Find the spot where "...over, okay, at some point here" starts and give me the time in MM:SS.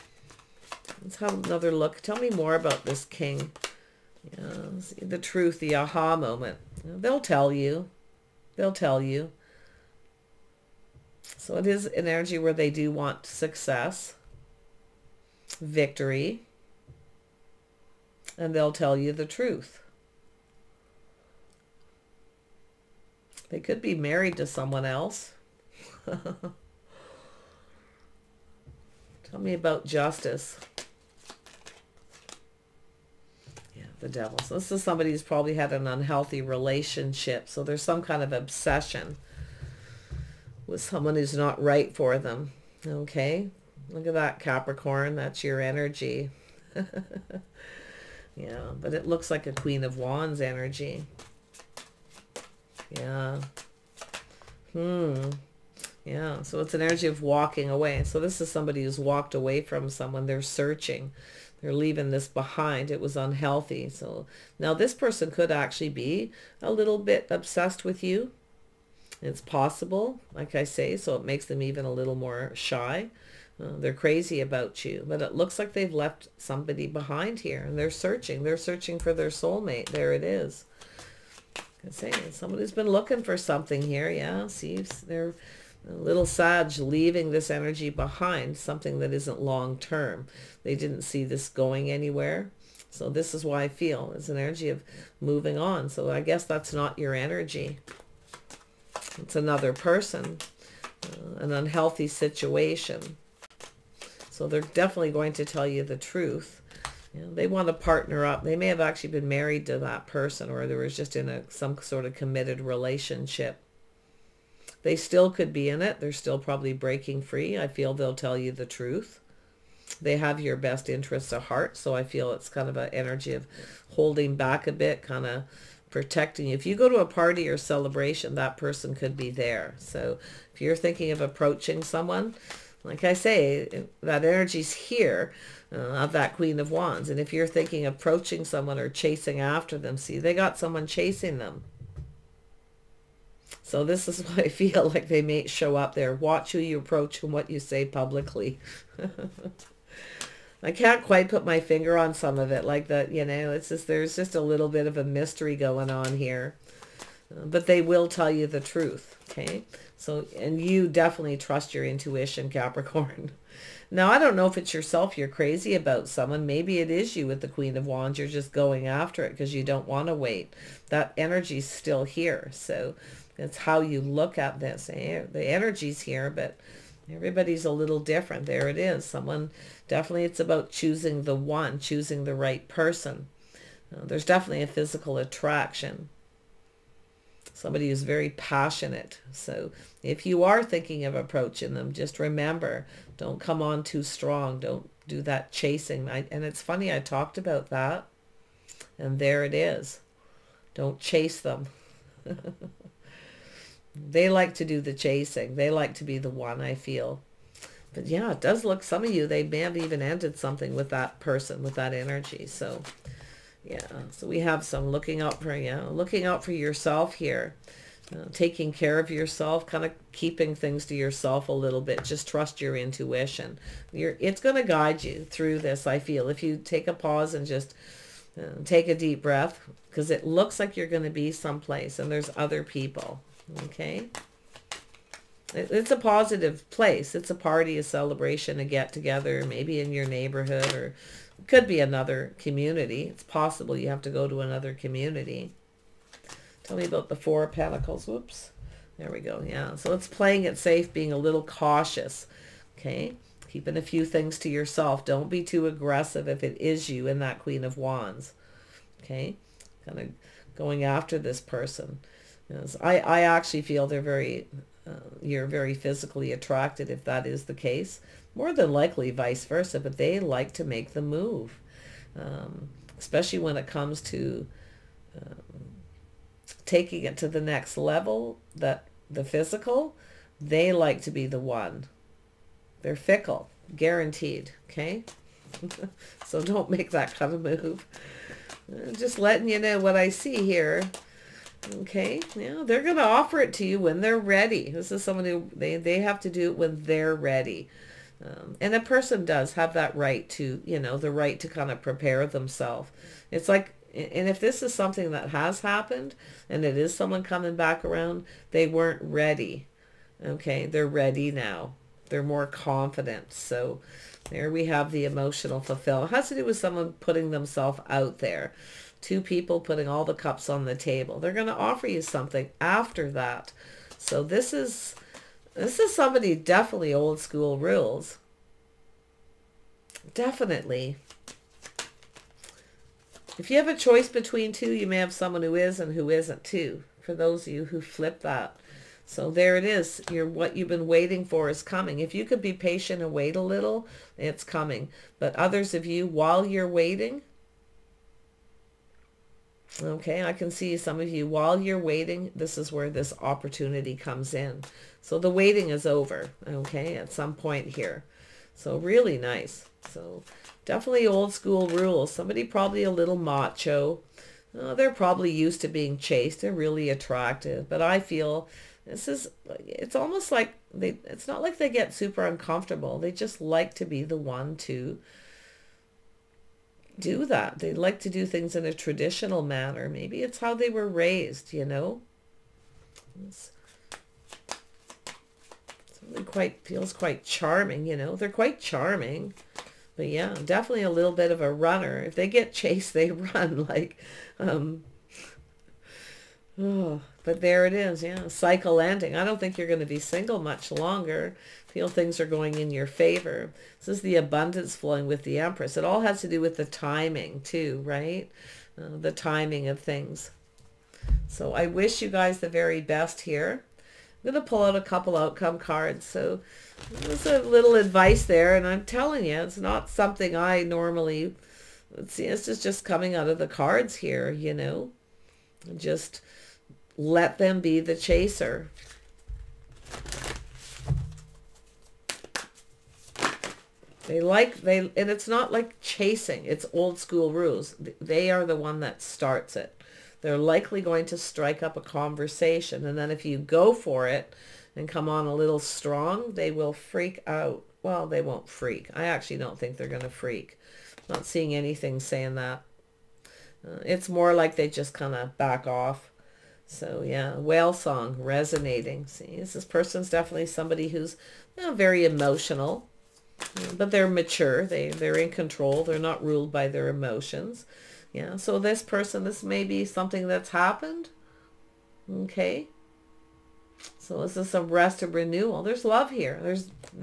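05:55.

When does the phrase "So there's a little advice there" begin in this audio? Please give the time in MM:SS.
06:56.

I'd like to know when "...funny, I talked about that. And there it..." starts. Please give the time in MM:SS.
03:16.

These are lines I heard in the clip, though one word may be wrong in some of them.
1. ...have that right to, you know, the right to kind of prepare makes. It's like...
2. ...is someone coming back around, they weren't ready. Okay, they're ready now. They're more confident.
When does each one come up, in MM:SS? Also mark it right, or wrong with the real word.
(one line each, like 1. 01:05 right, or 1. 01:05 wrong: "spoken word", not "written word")
1. 04:59 wrong: "themselves", not "makes"
2. 05:06 right.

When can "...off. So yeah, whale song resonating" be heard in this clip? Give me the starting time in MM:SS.
07:35.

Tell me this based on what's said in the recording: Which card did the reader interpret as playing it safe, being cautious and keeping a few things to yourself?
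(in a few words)
Four of Pentacles.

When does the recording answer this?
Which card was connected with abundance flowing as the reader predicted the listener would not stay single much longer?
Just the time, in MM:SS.
06:45.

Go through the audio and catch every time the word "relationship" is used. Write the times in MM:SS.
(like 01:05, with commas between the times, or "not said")
00:36, 01:52.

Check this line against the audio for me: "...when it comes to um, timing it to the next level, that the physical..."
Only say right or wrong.
wrong.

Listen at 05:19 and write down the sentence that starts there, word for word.
Two people putting all the cups on the table.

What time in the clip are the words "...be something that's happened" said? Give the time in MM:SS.
07:49.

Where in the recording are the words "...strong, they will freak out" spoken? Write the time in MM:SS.
07:25.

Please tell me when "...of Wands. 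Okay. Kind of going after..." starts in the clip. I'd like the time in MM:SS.
04:17.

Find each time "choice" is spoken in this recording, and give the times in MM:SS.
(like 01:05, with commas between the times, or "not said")
05:33.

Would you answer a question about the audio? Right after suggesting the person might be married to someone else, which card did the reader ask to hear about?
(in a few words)
Justice.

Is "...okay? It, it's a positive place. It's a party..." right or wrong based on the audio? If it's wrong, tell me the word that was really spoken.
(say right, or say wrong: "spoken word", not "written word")
right.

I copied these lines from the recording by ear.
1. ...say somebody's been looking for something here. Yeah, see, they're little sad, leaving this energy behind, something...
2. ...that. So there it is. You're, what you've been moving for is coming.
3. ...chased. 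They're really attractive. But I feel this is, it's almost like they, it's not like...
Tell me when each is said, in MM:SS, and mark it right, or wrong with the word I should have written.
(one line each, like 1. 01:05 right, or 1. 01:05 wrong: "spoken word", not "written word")
1. 01:21 right
2. 05:38 wrong: "waiting", not "moving"
3. 06:05 right.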